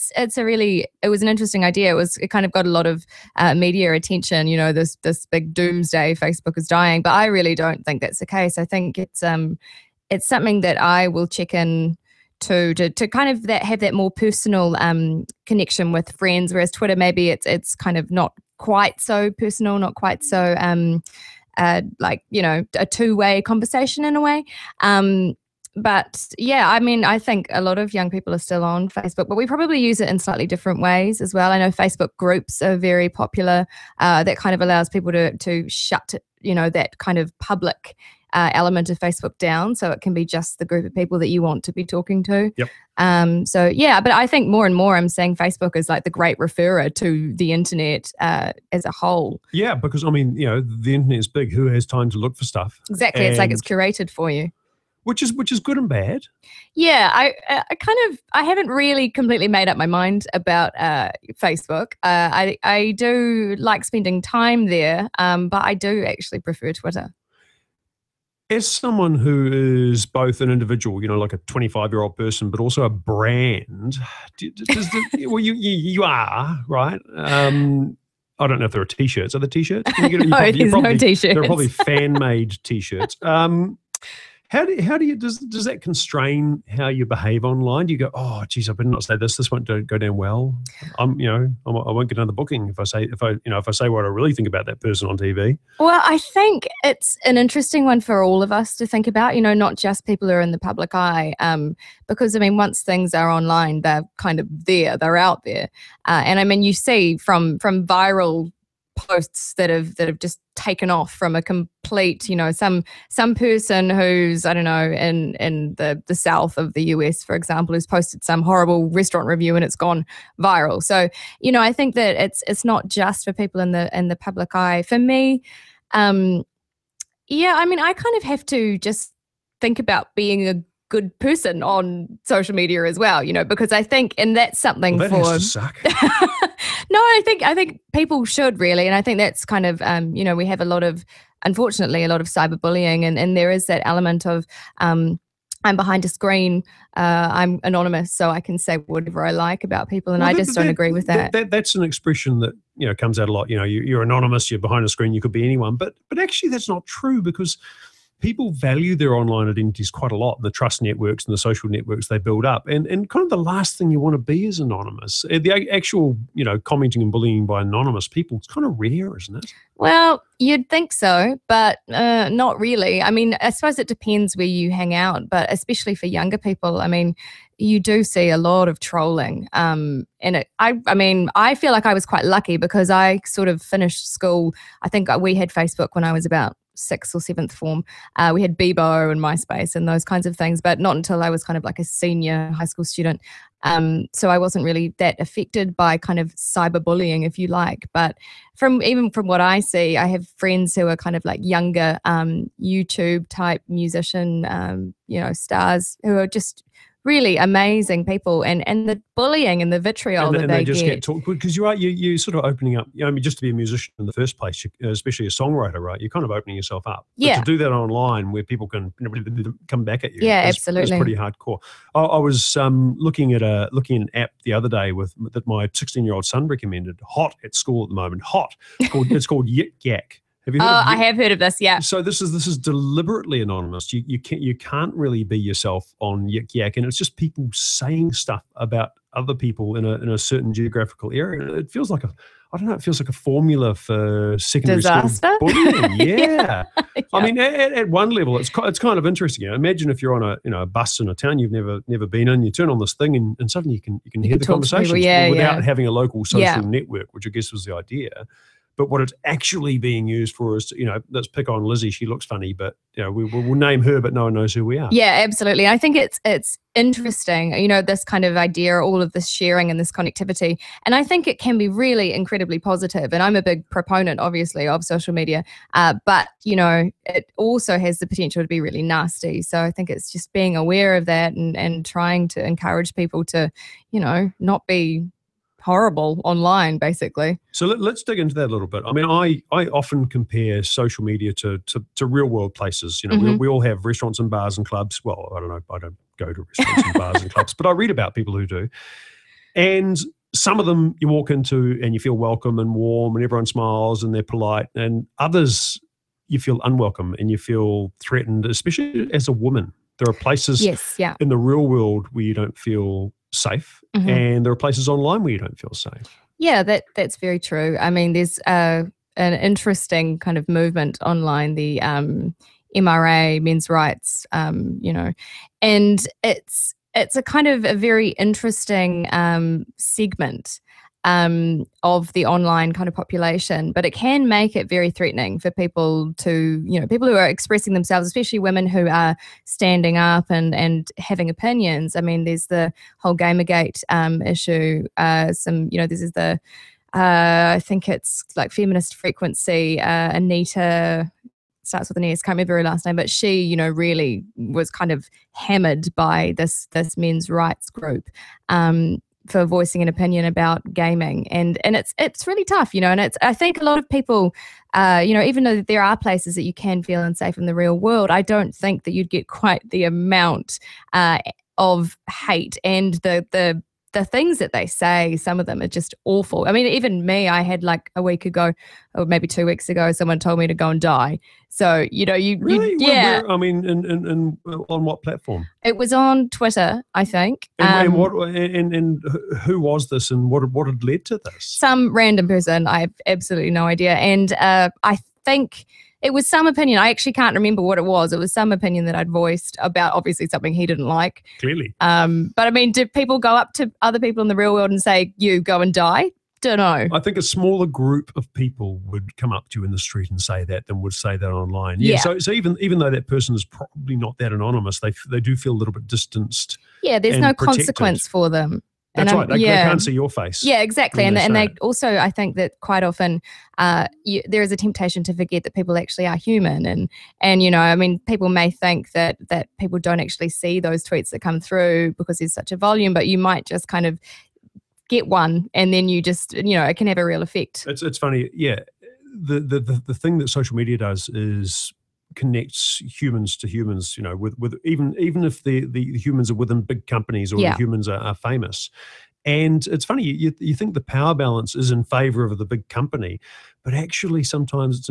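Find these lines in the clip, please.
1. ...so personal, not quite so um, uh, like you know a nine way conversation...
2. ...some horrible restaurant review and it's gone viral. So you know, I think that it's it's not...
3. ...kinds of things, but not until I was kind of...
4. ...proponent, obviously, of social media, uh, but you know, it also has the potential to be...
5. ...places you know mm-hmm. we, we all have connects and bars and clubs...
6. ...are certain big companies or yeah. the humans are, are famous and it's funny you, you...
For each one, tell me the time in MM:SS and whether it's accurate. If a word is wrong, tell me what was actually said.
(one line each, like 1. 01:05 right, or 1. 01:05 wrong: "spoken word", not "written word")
1. 00:19 wrong: "two", not "nine"
2. 01:58 right
3. 03:10 right
4. 04:33 right
5. 04:52 wrong: "restaurants", not "connects"
6. 07:26 wrong: "within", not "certain".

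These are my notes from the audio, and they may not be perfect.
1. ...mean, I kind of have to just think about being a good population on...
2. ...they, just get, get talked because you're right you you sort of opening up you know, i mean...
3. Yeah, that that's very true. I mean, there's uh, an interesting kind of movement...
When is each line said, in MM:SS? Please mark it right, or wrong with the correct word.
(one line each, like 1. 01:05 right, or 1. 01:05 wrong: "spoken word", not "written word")
1. 02:07 wrong: "person", not "population"
2. 03:30 right
3. 05:16 right.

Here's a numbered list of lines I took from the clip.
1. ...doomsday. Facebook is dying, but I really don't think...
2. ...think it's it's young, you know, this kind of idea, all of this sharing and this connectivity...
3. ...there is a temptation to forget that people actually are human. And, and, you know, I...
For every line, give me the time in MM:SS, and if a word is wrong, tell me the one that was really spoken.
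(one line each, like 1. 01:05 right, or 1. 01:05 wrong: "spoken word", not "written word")
1. 00:05 right
2. 04:25 wrong: "interesting", not "young"
3. 07:04 right.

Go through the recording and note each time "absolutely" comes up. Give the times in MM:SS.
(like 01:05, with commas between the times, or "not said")
03:40, 04:25, 06:33.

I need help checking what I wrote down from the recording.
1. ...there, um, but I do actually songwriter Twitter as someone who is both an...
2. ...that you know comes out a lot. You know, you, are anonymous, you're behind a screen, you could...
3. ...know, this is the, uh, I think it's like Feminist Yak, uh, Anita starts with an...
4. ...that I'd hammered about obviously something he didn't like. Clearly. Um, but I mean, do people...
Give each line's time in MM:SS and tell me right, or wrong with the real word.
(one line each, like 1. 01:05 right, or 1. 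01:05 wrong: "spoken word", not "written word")
1. 01:04 wrong: "prefer", not "songwriter"
2. 02:32 right
3. 05:45 wrong: "Frequency", not "Yak"
4. 06:38 wrong: "voiced", not "hammered".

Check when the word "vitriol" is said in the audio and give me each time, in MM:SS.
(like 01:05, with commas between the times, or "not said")
03:29.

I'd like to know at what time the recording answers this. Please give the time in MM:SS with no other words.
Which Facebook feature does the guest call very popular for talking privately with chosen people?
00:31.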